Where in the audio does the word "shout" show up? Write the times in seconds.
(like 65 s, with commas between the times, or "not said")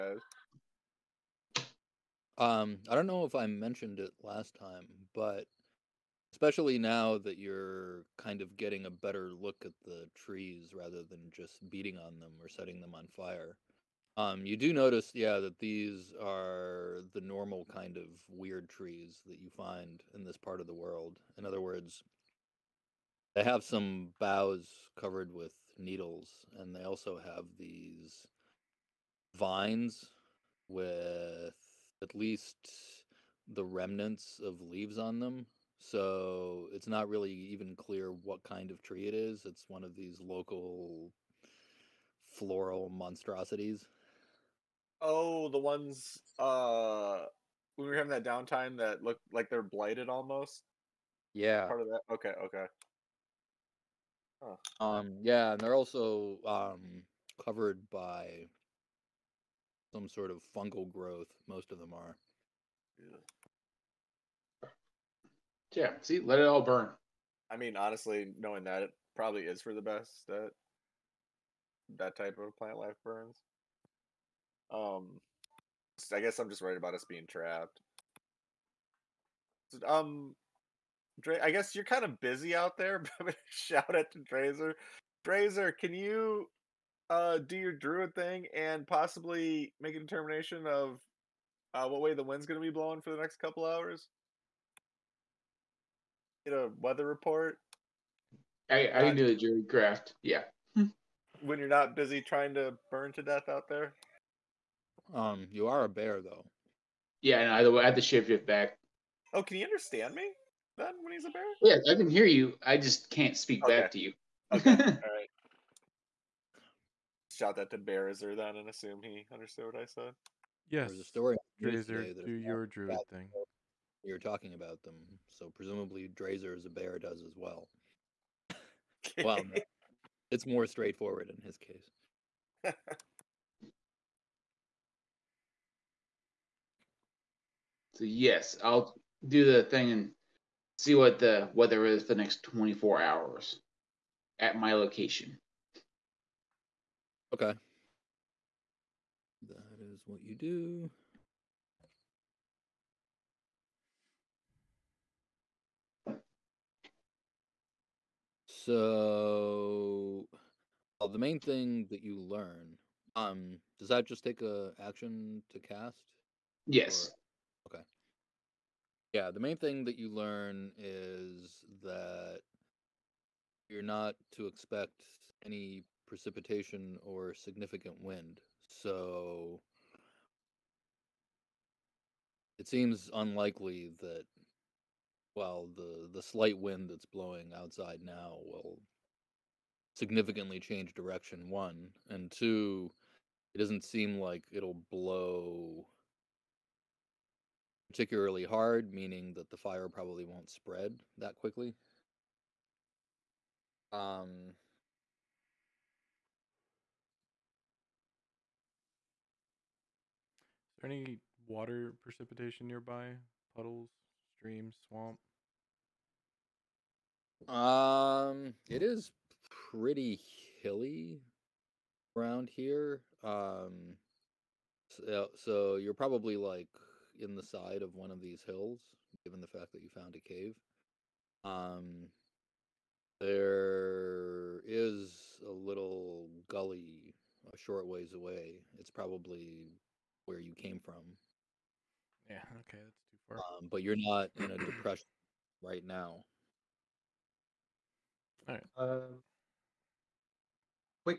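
83 s, 117 s.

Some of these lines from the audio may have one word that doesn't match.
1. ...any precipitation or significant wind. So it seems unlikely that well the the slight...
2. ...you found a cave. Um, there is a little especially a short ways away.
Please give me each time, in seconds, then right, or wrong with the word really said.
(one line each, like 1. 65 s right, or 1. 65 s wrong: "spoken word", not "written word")
1. 175 s right
2. 229 s wrong: "gully", not "especially".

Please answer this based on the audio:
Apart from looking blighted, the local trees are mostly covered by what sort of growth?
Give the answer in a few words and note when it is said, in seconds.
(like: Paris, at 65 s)
fungal growth, at 60 s.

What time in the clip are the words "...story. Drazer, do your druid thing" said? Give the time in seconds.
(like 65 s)
121 s.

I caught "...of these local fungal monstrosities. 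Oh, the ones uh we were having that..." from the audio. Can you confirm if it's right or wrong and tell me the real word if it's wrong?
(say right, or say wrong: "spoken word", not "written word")
wrong: "floral", not "fungal".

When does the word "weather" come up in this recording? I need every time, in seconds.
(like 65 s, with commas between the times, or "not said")
96 s, 141 s.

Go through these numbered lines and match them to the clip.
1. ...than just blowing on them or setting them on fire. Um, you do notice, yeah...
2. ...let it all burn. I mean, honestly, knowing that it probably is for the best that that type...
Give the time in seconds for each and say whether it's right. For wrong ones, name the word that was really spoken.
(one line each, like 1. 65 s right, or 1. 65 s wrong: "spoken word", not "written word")
1. 11 s wrong: "beating", not "blowing"
2. 66 s right.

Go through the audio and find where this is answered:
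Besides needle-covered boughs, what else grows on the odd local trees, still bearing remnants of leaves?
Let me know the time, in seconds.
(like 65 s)
29 s.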